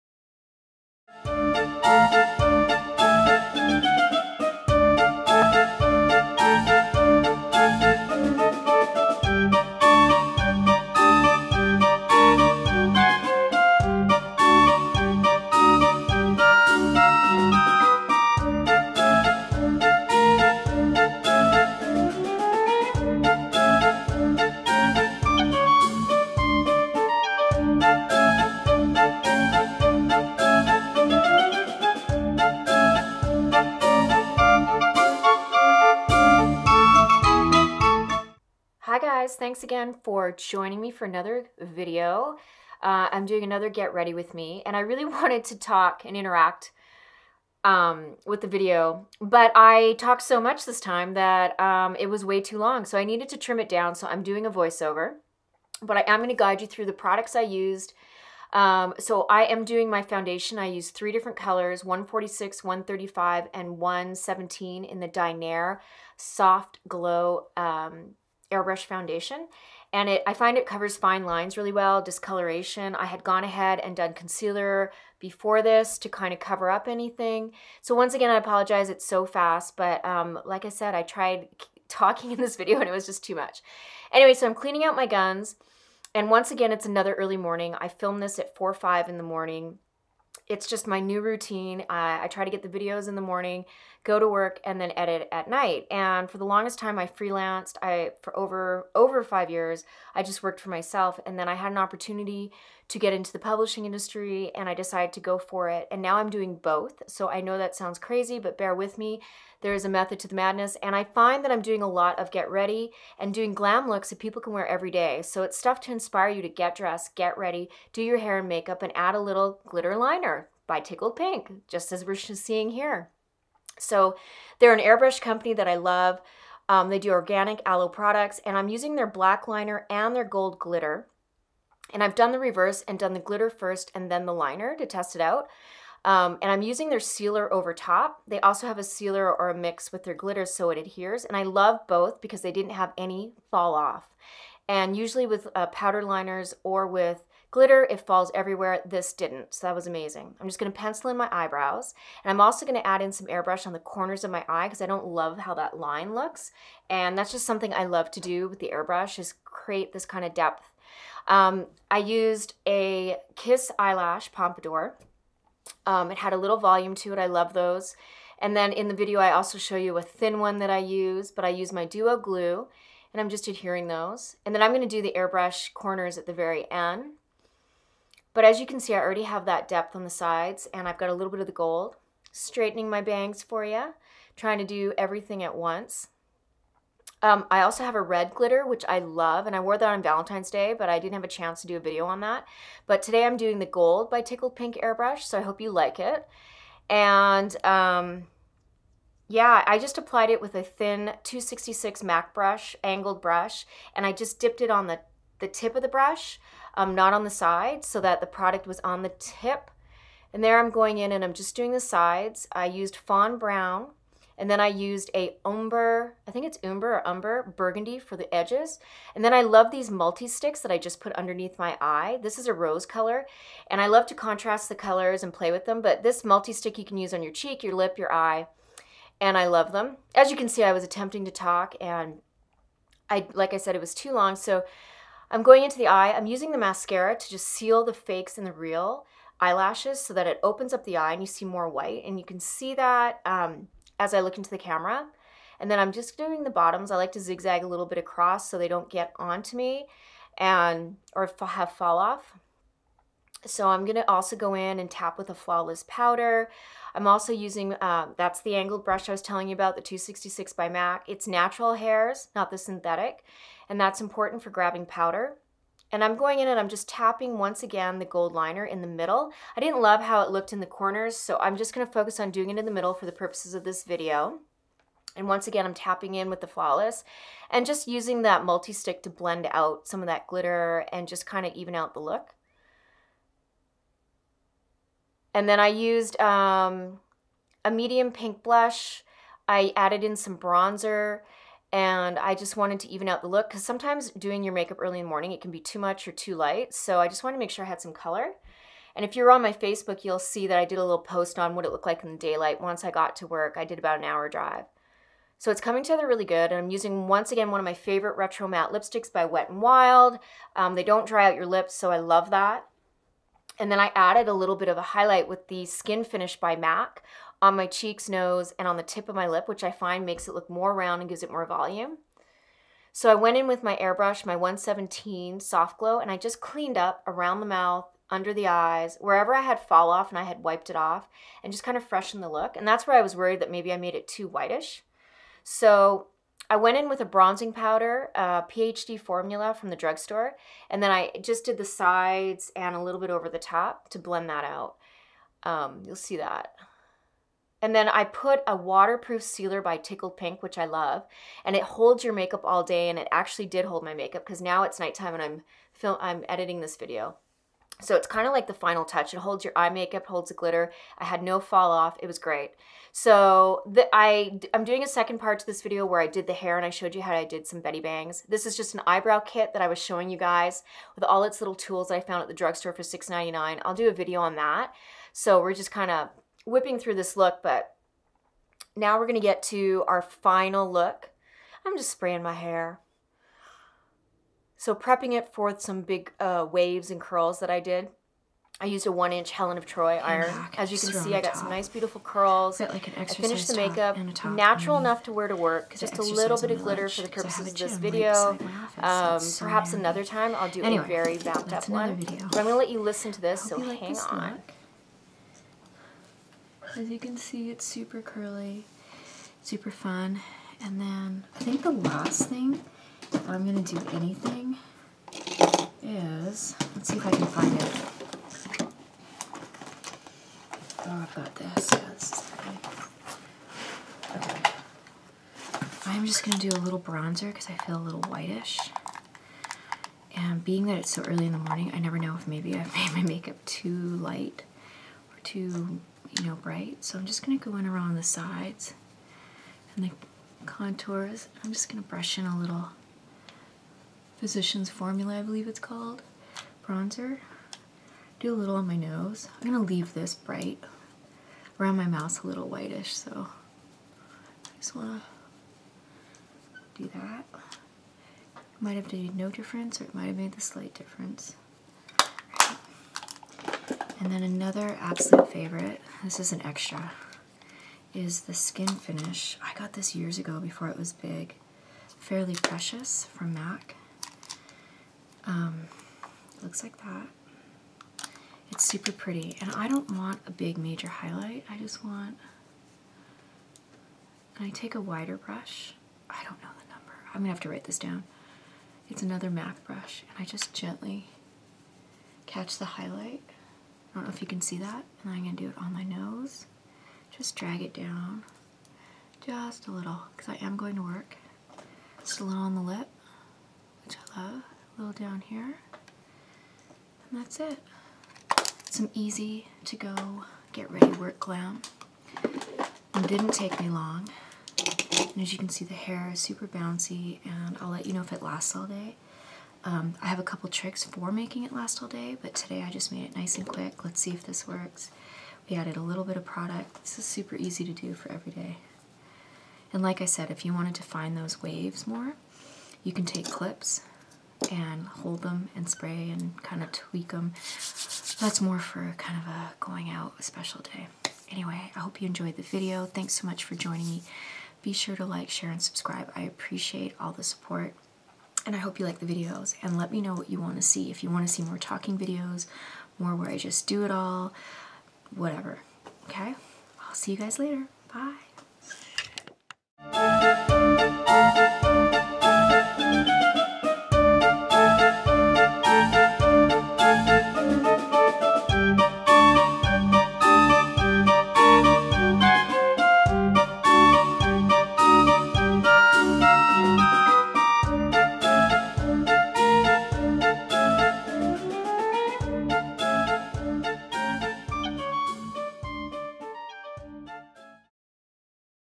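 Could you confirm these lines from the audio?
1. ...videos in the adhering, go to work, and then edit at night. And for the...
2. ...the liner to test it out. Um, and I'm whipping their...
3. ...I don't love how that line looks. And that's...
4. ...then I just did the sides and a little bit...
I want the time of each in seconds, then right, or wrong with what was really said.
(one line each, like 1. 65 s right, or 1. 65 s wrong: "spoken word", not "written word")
1. 92 s wrong: "morning", not "adhering"
2. 134 s wrong: "using", not "whipping"
3. 154 s right
4. 340 s right.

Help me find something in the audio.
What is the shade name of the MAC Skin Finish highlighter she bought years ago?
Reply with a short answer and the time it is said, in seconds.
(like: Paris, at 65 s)
Fairly Precious, at 471 s.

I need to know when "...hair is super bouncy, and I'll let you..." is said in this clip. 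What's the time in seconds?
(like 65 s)
515 s.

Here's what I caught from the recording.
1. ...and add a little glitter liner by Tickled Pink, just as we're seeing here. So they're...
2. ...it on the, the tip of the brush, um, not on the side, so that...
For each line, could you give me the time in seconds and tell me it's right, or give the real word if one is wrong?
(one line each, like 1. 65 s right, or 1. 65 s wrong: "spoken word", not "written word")
1. 118 s right
2. 204 s right.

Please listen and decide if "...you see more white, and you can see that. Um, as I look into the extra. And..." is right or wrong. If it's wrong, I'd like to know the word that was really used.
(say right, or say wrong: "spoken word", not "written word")
wrong: "camera", not "extra".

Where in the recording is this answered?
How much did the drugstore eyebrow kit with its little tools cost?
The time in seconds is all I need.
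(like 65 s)
372 s.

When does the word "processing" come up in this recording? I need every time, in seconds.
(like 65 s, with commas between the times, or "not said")
not said.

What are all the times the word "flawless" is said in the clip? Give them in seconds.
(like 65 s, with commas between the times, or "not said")
255 s, 276 s.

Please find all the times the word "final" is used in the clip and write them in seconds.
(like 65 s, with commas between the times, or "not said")
358 s, 380 s.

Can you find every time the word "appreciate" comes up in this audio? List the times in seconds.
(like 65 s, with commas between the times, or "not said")
546 s.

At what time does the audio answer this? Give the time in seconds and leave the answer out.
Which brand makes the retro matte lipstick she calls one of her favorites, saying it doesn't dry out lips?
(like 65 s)
309 s.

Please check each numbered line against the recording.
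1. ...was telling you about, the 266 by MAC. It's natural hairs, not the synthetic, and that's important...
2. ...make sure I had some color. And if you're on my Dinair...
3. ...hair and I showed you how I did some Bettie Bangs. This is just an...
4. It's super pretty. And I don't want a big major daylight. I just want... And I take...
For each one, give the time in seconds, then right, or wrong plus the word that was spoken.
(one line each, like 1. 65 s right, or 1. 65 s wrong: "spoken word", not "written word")
1. 259 s right
2. 297 s wrong: "Facebook", not "Dinair"
3. 366 s right
4. 478 s wrong: "highlight", not "daylight".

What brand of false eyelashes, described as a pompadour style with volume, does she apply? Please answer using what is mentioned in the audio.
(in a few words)
Kiss.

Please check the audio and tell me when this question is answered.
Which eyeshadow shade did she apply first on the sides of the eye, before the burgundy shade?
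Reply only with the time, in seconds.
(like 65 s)
212 s.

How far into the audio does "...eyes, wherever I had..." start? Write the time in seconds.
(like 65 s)
328 s.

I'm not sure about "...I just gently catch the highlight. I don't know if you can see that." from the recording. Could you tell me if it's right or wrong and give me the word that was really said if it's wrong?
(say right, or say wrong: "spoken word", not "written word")
right.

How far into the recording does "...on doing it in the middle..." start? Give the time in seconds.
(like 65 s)
272 s.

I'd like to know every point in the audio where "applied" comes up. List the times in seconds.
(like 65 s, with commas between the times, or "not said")
199 s.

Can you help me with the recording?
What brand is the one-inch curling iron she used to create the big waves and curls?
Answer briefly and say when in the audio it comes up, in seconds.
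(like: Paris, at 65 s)
Helen of Troy, at 389 s.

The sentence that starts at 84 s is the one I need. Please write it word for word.
Anyway, so I'm cleaning out my guns, and once again, it's another early morning.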